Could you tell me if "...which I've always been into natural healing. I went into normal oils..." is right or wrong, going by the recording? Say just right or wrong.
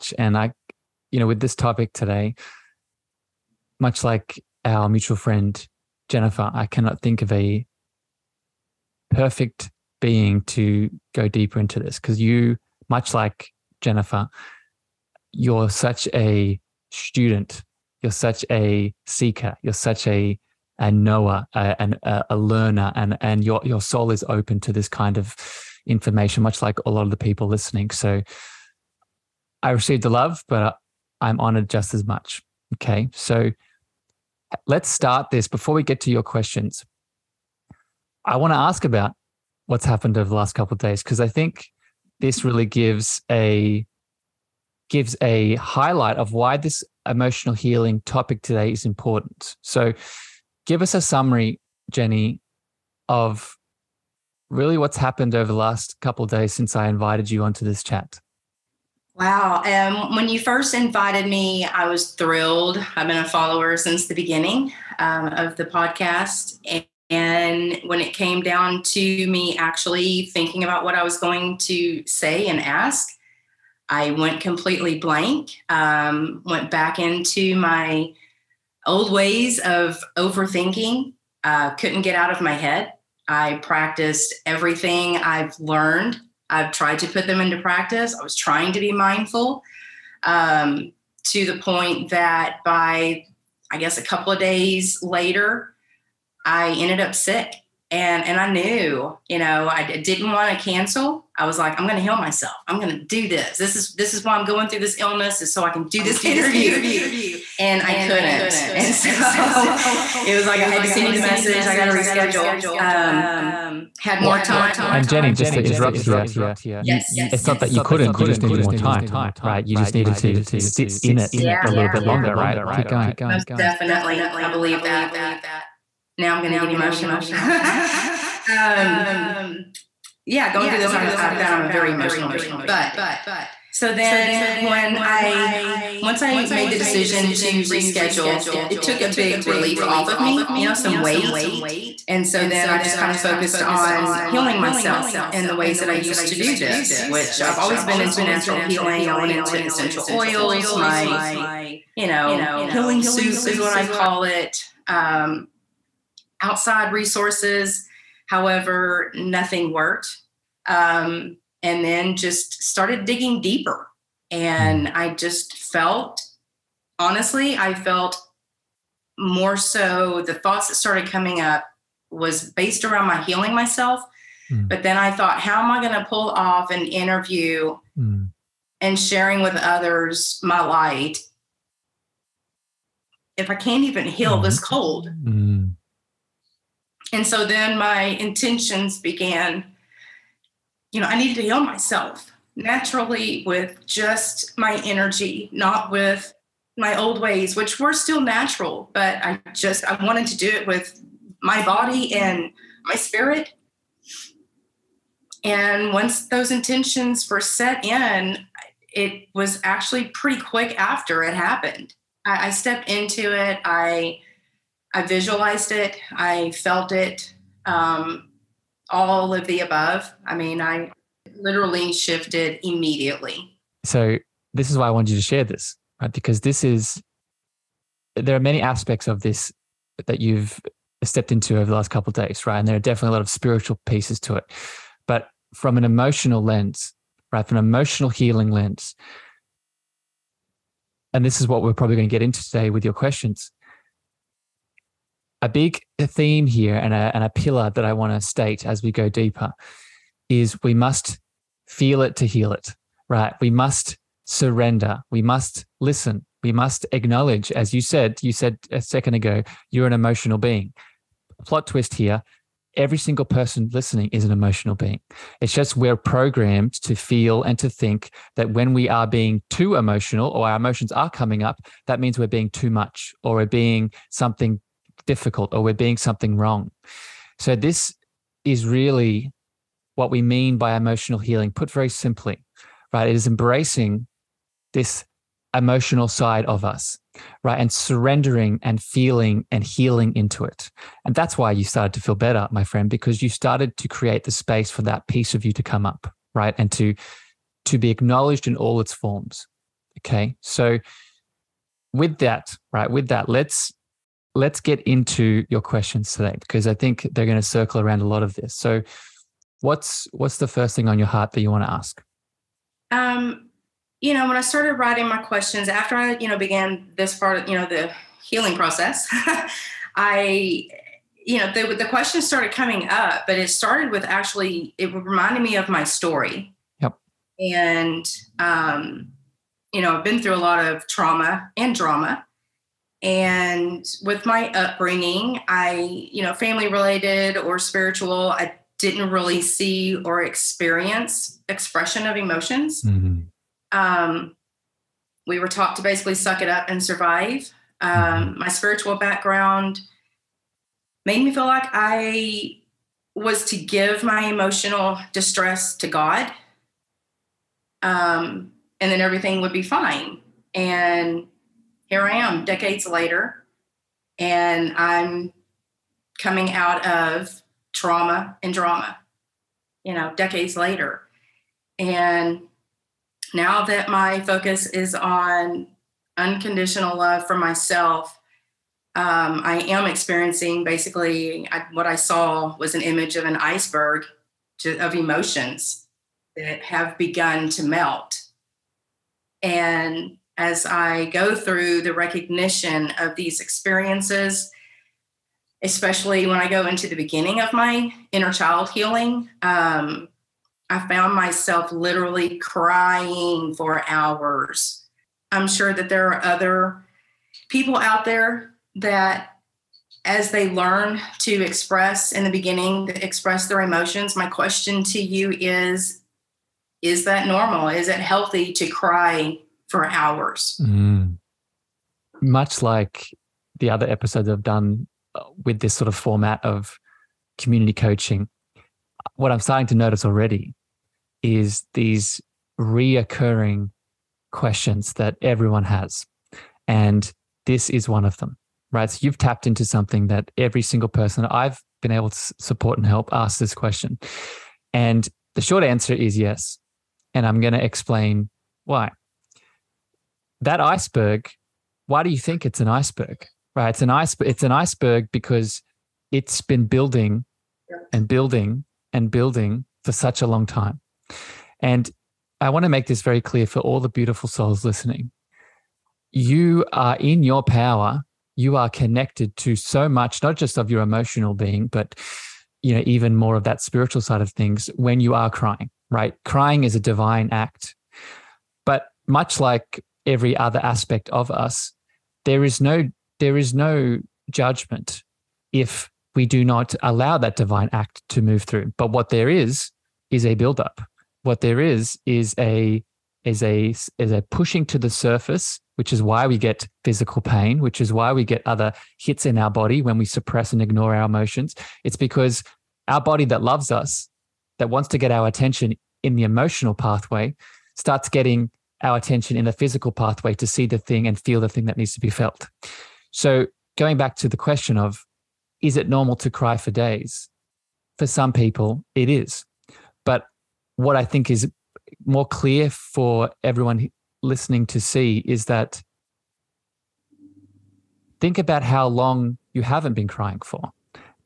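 wrong.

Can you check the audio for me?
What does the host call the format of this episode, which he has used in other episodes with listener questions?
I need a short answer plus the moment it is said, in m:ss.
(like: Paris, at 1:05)
Community coaching, at 7:07.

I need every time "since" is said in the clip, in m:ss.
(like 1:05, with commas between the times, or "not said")
0:56, 1:03.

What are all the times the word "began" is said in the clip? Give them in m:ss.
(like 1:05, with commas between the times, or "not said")
3:08, 5:16.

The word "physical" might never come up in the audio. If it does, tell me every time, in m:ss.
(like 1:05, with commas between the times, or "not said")
8:16, 8:29.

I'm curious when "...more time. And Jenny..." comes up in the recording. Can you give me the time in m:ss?
1:54.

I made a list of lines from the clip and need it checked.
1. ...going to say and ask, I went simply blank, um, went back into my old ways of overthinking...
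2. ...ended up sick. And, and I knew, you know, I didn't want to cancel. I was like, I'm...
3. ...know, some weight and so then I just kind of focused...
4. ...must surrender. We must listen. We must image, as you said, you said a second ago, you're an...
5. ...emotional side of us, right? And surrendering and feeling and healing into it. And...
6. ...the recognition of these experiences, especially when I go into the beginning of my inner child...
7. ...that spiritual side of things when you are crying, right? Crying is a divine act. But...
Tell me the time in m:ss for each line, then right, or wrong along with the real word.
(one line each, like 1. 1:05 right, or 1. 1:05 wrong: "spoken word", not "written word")
1. 1:11 wrong: "completely", not "simply"
2. 1:36 right
3. 2:20 right
4. 4:13 wrong: "acknowledge", not "image"
5. 4:45 right
6. 6:31 right
7. 7:53 right.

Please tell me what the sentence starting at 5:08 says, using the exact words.
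So what's what's the first thing on your heart that you want to ask?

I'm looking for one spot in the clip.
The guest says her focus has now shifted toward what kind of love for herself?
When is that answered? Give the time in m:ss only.
6:16.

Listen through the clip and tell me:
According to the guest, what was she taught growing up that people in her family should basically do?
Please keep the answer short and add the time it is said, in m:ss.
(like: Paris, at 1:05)
Suck it up and survive, at 5:46.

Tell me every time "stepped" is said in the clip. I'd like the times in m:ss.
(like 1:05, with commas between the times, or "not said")
3:32, 3:51.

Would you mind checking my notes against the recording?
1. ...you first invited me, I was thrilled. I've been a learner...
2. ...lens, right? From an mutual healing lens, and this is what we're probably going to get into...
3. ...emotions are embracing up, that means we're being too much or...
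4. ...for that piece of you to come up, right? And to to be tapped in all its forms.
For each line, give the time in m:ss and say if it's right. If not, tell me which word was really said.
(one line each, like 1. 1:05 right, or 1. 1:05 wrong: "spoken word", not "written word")
1. 1:00 wrong: "follower", not "learner"
2. 3:56 wrong: "emotional", not "mutual"
3. 4:30 wrong: "coming", not "embracing"
4. 4:54 wrong: "acknowledged", not "tapped".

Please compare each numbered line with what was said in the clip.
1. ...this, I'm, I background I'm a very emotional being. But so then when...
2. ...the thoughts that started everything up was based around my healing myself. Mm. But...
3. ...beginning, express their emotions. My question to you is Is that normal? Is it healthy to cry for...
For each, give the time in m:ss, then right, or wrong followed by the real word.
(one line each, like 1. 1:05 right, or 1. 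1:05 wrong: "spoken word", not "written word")
1. 2:10 wrong: "found", not "background"
2. 2:50 wrong: "coming", not "everything"
3. 6:52 right.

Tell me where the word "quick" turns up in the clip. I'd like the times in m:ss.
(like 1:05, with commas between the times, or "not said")
3:30.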